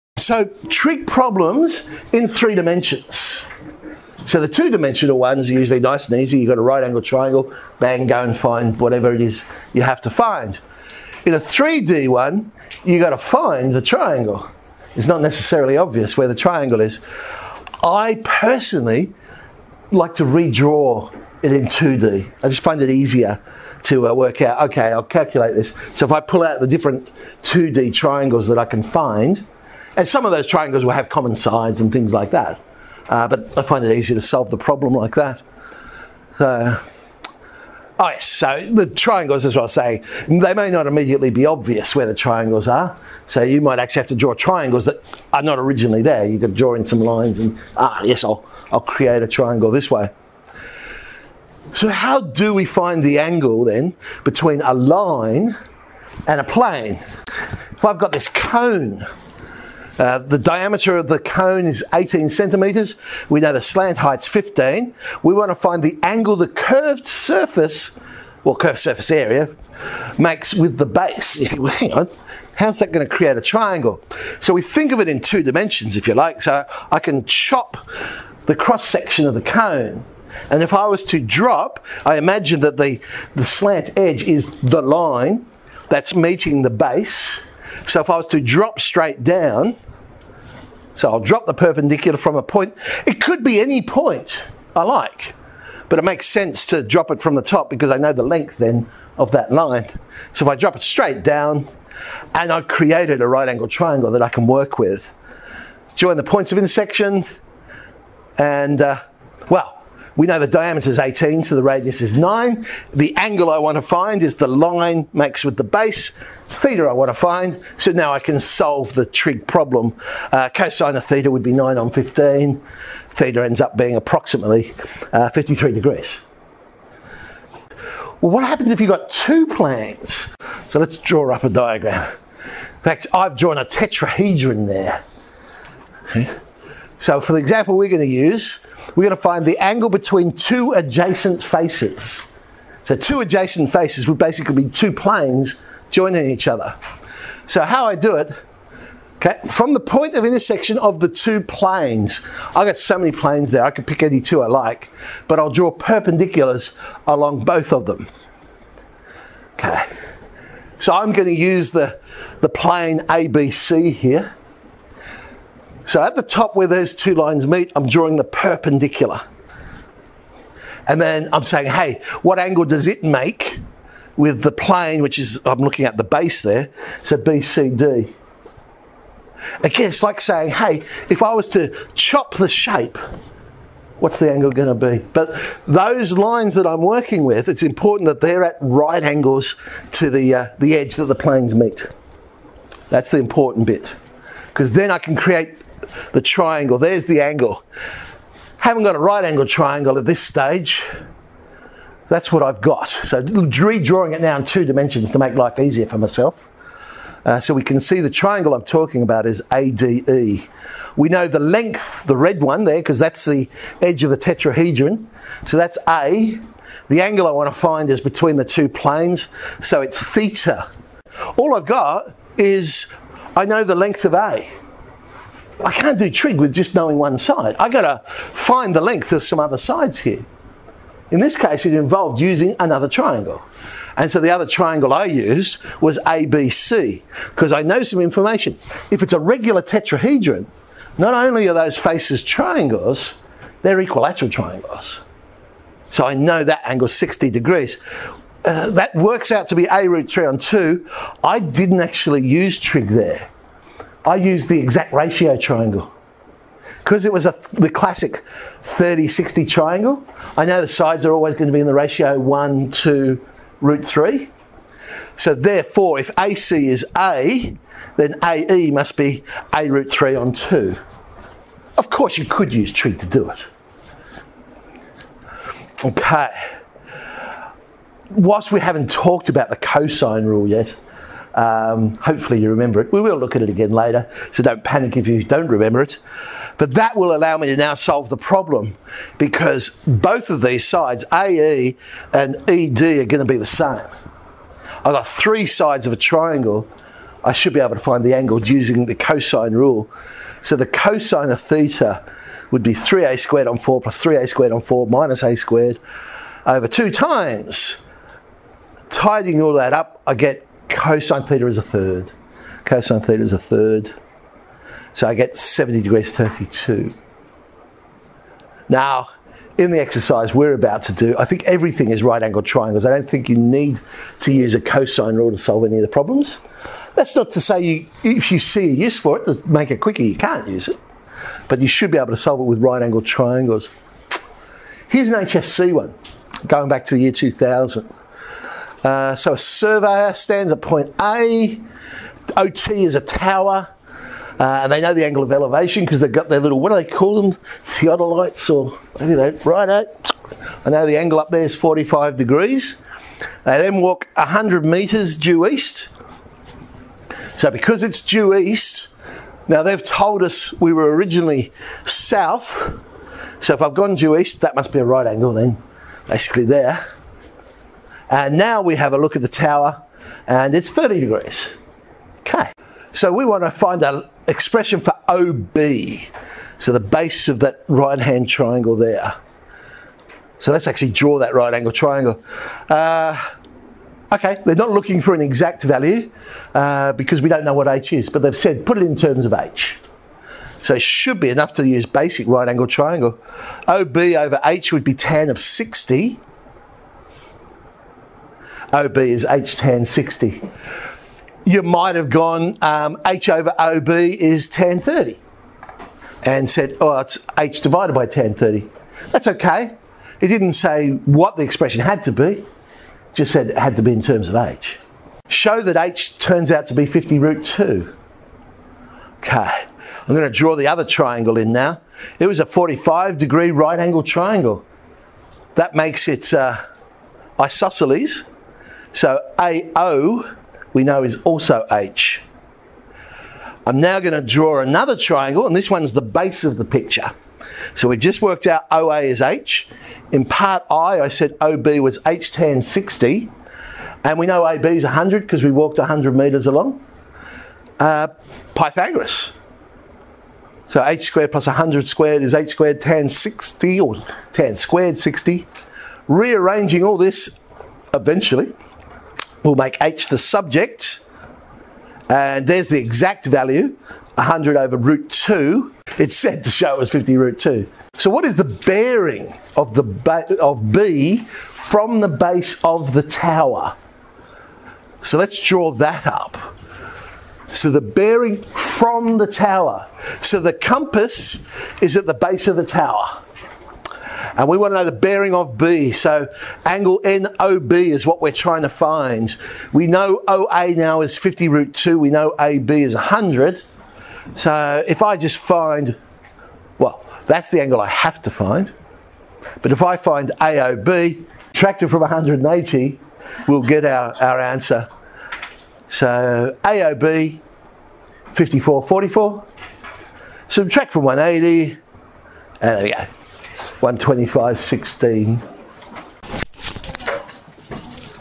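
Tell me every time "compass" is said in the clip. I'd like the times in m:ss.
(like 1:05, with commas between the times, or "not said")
8:00.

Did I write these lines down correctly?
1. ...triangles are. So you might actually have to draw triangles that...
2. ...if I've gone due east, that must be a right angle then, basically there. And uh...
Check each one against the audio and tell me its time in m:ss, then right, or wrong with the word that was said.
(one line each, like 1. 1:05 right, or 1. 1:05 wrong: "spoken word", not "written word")
1. 0:42 right
2. 6:03 right.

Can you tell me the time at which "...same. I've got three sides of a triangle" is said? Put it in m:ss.
4:53.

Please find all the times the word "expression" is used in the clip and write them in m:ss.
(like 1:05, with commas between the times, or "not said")
6:14, 6:51.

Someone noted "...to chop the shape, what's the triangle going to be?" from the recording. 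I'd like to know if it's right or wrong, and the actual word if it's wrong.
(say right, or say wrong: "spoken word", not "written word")
wrong: "angle", not "triangle".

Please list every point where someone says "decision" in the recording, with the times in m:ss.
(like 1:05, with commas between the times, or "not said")
not said.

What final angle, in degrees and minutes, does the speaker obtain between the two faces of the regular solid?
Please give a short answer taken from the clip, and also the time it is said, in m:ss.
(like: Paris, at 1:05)
70 degrees 32, at 5:15.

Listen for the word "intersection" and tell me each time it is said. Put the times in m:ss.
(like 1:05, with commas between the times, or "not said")
1:46, 2:30.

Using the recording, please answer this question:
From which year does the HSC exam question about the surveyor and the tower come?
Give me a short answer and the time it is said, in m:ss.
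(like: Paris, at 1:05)
2000, at 5:37.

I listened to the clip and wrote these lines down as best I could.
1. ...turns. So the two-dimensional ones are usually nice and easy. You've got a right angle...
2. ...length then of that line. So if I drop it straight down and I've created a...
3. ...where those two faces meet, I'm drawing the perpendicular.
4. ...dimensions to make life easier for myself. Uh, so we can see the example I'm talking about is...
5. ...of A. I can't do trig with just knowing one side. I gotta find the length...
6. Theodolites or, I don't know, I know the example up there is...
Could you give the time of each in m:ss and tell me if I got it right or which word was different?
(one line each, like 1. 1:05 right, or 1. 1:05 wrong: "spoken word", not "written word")
1. 0:02 wrong: "dimensions", not "turns"
2. 1:38 right
3. 2:46 wrong: "lines", not "faces"
4. 3:24 wrong: "triangle", not "example"
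5. 3:44 right
6. 5:47 wrong: "angle", not "example".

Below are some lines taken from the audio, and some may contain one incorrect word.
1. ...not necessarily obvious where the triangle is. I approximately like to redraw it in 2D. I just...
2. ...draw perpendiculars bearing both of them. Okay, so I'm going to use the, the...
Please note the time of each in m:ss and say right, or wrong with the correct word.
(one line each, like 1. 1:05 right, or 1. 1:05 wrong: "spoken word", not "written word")
1. 0:15 wrong: "personally", not "approximately"
2. 2:35 wrong: "along", not "bearing".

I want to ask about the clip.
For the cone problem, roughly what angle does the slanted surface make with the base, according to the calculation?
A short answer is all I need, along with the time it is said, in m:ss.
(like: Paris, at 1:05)
53 degrees, at 2:05.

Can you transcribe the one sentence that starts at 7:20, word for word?
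In part I, I said OB was H tan 60, and we know AB is 100 because we walked 100 metres along.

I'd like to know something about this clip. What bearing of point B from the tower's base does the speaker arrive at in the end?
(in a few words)
125.16.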